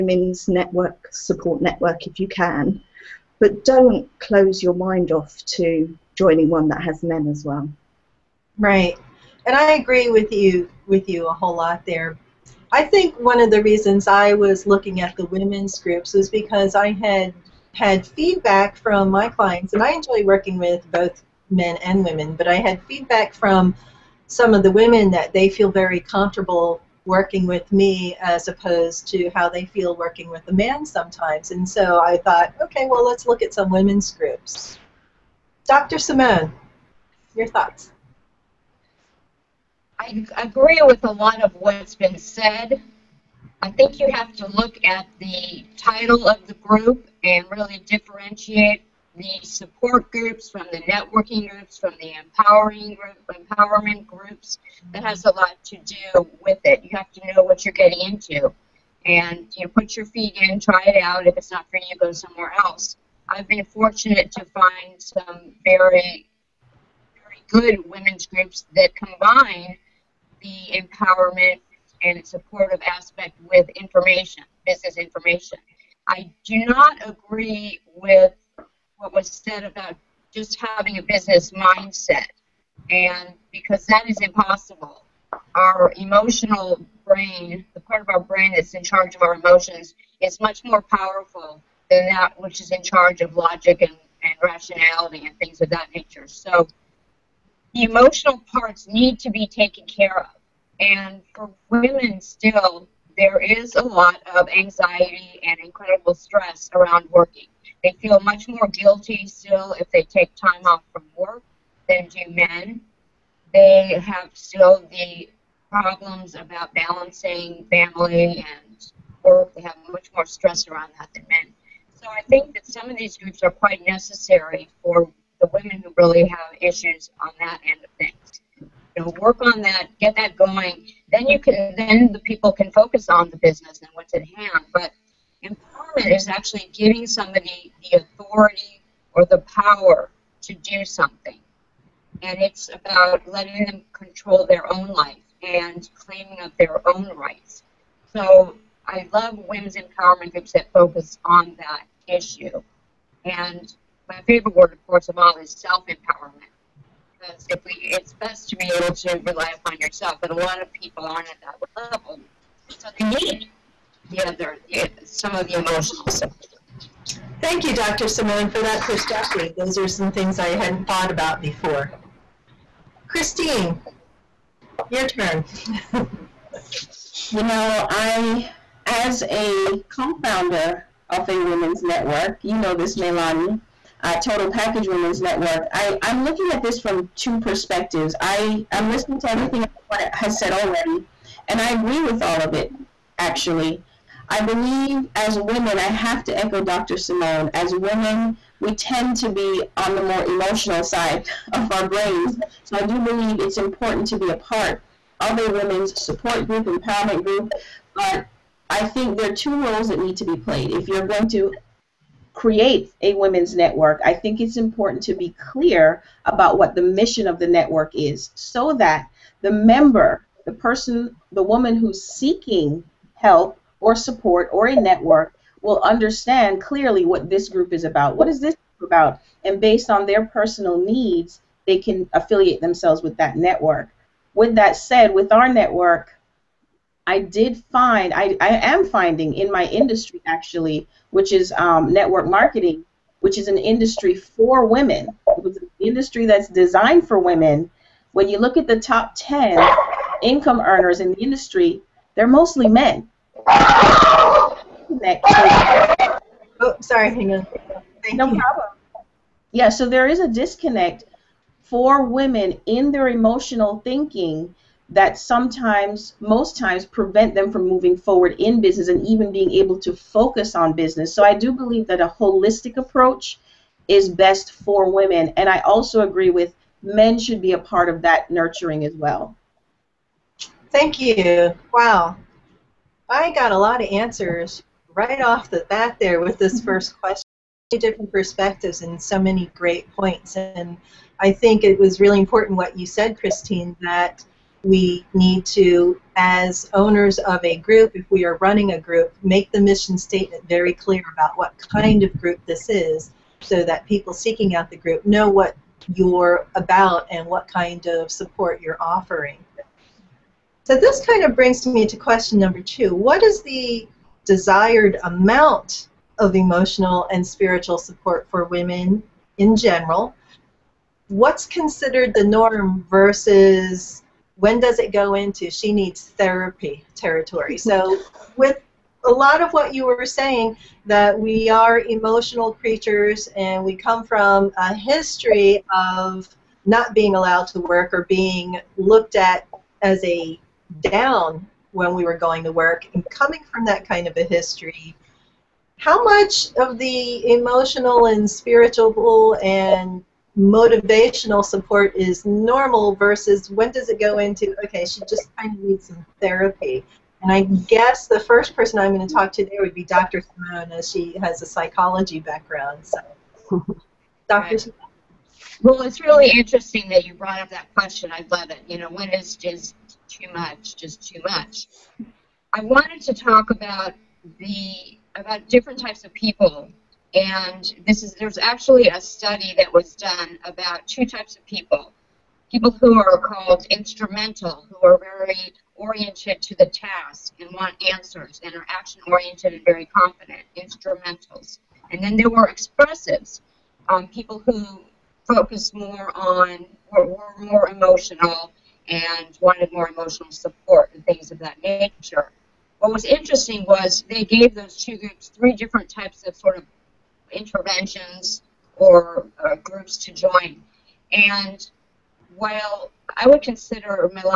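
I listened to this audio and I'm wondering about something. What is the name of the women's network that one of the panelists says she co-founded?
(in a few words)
Total Package Women's Network.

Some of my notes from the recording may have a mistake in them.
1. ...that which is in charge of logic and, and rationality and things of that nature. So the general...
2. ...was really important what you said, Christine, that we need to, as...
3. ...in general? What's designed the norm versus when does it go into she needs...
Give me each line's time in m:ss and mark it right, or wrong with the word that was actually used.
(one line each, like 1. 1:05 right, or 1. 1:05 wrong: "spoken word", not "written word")
1. 1:32 wrong: "emotional", not "general"
2. 4:51 right
3. 5:19 wrong: "considered", not "designed".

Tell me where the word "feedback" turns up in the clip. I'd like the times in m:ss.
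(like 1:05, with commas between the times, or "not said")
0:18, 0:22.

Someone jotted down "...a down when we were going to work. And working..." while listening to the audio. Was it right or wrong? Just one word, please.
wrong.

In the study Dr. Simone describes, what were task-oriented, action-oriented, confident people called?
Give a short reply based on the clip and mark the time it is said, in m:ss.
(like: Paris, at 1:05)
Instrumental, at 6:23.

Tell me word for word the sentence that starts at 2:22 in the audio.
And it's about letting them control their own life and claiming up their own rights.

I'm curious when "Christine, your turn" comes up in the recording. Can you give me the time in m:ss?
2:53.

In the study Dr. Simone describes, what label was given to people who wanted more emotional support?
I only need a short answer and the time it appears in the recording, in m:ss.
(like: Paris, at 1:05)
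Expressives, at 6:32.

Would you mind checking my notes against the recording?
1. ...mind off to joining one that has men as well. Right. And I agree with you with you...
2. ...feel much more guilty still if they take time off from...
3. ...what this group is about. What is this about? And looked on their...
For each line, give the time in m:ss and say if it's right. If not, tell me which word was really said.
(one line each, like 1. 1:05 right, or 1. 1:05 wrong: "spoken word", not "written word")
1. 0:04 right
2. 1:48 right
3. 3:47 wrong: "based", not "looked".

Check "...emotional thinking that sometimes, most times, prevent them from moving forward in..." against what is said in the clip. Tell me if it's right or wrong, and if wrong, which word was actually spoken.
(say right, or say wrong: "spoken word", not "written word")
right.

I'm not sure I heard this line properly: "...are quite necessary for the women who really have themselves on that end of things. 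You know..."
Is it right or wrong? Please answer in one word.
wrong.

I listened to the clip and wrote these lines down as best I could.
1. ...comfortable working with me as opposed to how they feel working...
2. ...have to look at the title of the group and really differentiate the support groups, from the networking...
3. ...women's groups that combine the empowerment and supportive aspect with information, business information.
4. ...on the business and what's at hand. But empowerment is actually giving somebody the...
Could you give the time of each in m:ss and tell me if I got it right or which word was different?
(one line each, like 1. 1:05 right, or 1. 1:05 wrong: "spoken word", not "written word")
1. 0:25 right
2. 0:44 right
3. 1:07 right
4. 2:13 right.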